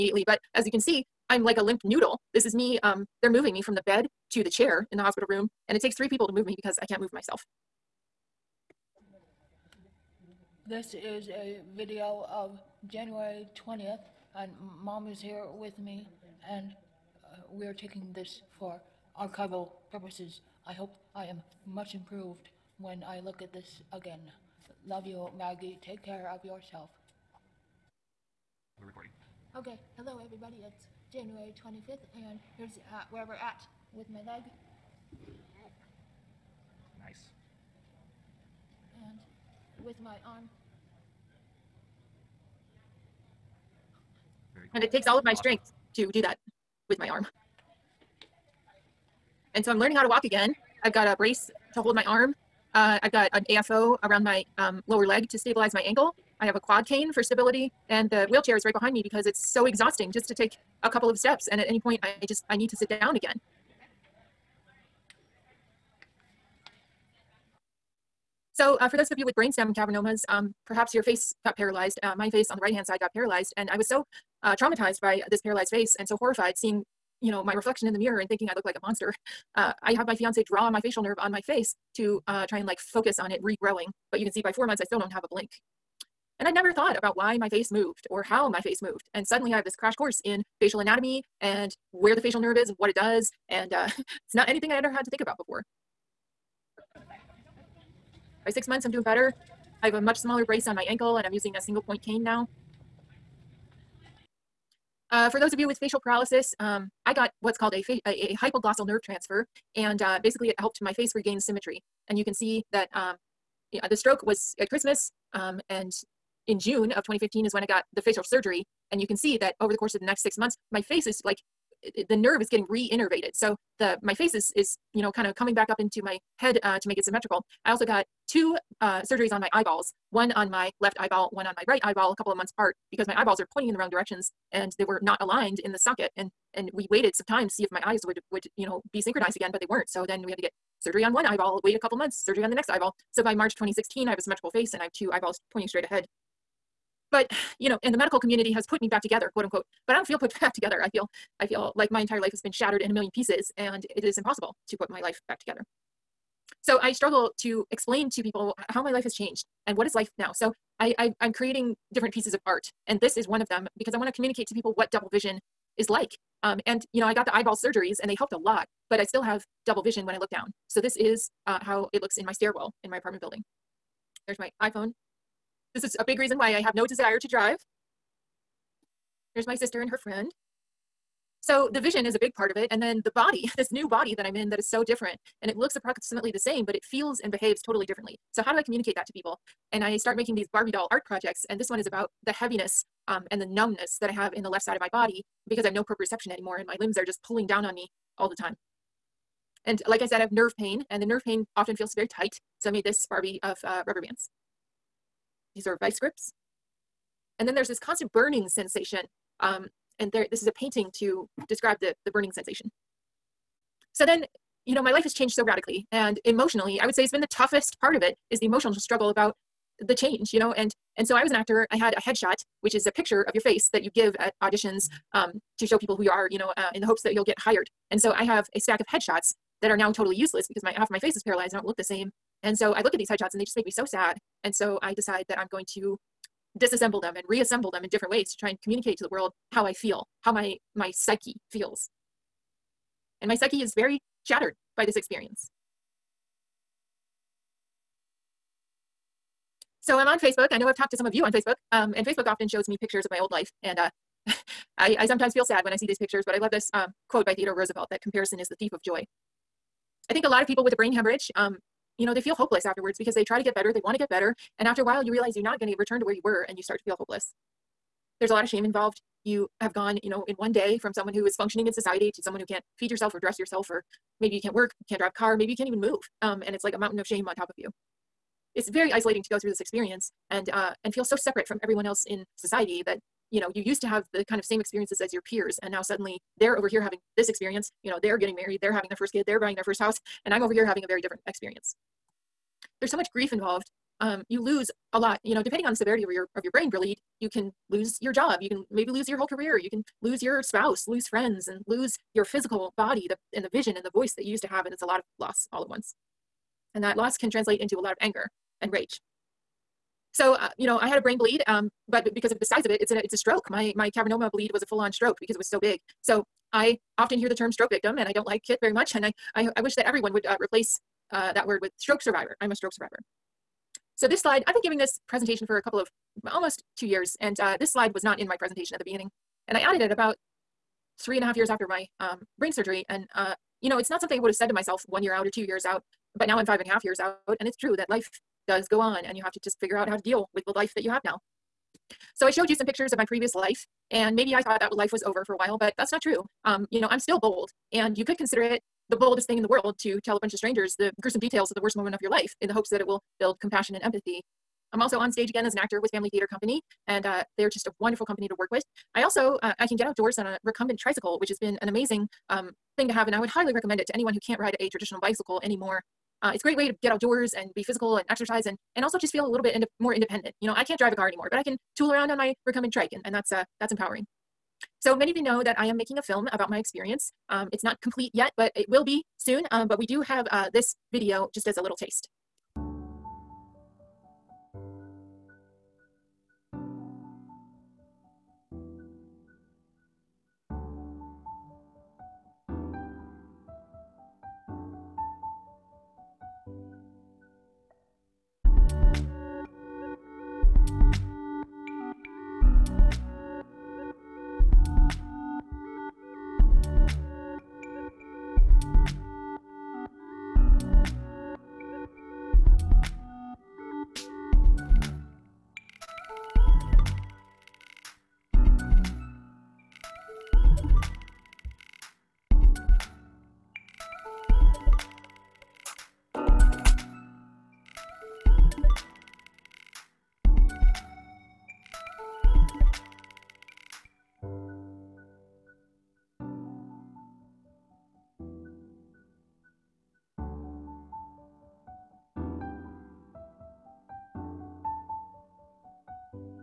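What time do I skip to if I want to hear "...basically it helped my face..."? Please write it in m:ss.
1:50.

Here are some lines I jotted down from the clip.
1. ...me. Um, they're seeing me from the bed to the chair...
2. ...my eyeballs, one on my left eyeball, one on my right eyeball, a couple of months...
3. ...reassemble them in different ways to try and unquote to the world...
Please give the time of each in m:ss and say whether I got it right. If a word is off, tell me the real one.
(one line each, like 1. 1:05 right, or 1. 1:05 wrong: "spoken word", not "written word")
1. 0:02 wrong: "moving", not "seeing"
2. 2:09 right
3. 3:57 wrong: "communicate", not "unquote".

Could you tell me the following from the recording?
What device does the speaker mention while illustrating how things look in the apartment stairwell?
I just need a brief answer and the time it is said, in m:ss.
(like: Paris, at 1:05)
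iPhone, at 2:54.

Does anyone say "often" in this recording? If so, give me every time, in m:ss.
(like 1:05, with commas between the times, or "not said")
3:21, 4:12, 5:16.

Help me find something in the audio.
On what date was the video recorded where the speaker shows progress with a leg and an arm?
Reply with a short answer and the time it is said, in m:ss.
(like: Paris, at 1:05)
January 25, at 0:31.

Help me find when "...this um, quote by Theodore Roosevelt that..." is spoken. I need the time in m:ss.
4:16.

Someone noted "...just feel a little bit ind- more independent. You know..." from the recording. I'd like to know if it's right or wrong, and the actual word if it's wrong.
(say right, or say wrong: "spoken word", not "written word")
right.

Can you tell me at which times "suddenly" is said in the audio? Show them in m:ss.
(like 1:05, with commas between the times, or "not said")
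1:29, 4:45.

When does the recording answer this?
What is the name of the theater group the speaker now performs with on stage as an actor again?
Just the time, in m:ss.
5:55.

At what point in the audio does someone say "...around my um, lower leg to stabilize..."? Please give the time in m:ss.
0:54.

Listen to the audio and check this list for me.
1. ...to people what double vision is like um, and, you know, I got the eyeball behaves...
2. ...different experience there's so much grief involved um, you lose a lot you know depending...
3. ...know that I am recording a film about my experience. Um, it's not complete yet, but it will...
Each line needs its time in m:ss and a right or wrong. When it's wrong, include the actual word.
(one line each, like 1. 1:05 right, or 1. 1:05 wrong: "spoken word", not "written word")
1. 2:44 wrong: "surgeries", not "behaves"
2. 4:50 right
3. 6:15 wrong: "making", not "recording".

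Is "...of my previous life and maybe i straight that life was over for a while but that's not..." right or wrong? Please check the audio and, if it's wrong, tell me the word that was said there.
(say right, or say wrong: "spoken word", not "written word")
wrong: "thought", not "straight".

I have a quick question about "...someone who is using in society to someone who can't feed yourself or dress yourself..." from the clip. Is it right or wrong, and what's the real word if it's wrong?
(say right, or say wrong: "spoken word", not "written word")
wrong: "functioning", not "using".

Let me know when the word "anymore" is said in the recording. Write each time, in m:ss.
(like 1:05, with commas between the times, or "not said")
3:16, 6:05, 6:11.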